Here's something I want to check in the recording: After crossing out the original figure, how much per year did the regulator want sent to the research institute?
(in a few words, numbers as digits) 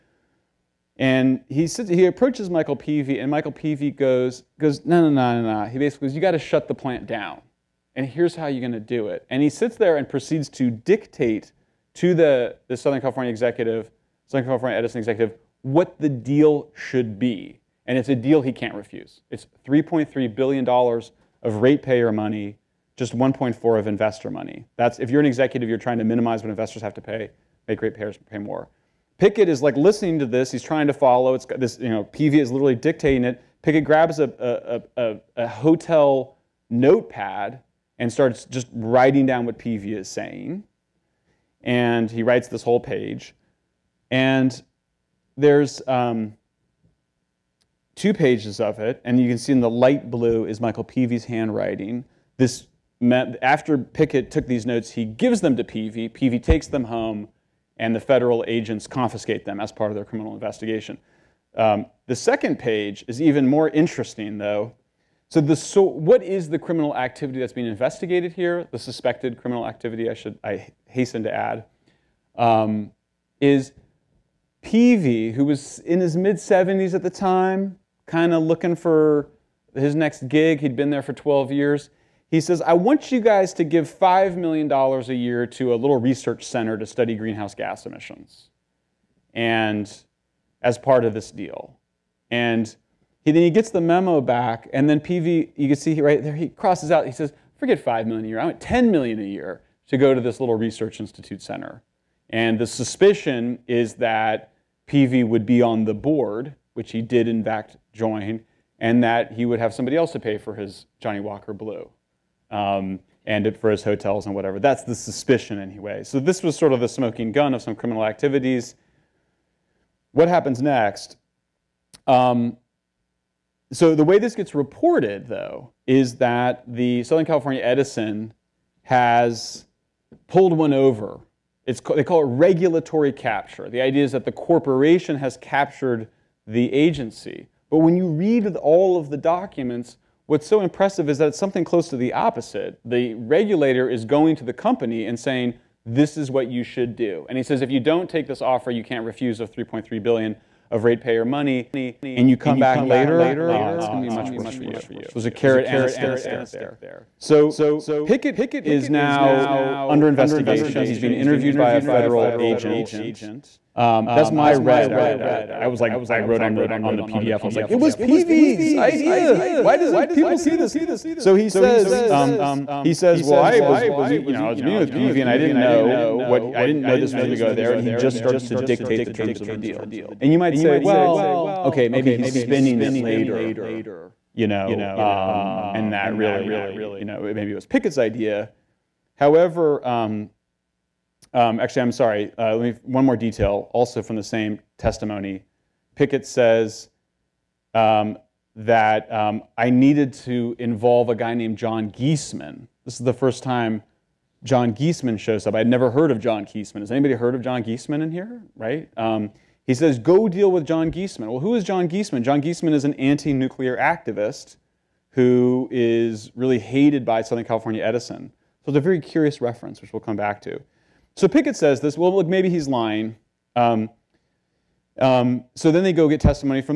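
$10 million.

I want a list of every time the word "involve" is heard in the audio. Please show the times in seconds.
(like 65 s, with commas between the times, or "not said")
200 s.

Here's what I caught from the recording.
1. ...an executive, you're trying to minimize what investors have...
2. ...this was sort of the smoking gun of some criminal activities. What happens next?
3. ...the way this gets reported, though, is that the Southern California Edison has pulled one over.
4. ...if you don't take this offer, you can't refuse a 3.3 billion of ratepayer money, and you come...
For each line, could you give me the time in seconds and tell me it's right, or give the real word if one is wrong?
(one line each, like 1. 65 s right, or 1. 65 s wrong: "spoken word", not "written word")
1. 25 s right
2. 116 s right
3. 123 s right
4. 147 s right.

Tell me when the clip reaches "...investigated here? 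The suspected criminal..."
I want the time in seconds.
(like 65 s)
67 s.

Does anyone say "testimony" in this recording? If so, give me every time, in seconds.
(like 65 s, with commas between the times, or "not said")
194 s, 226 s.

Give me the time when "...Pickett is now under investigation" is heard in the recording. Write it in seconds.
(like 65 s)
158 s.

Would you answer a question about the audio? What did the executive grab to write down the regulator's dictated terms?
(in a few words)
a hotel notepad.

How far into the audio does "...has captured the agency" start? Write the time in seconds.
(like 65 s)
135 s.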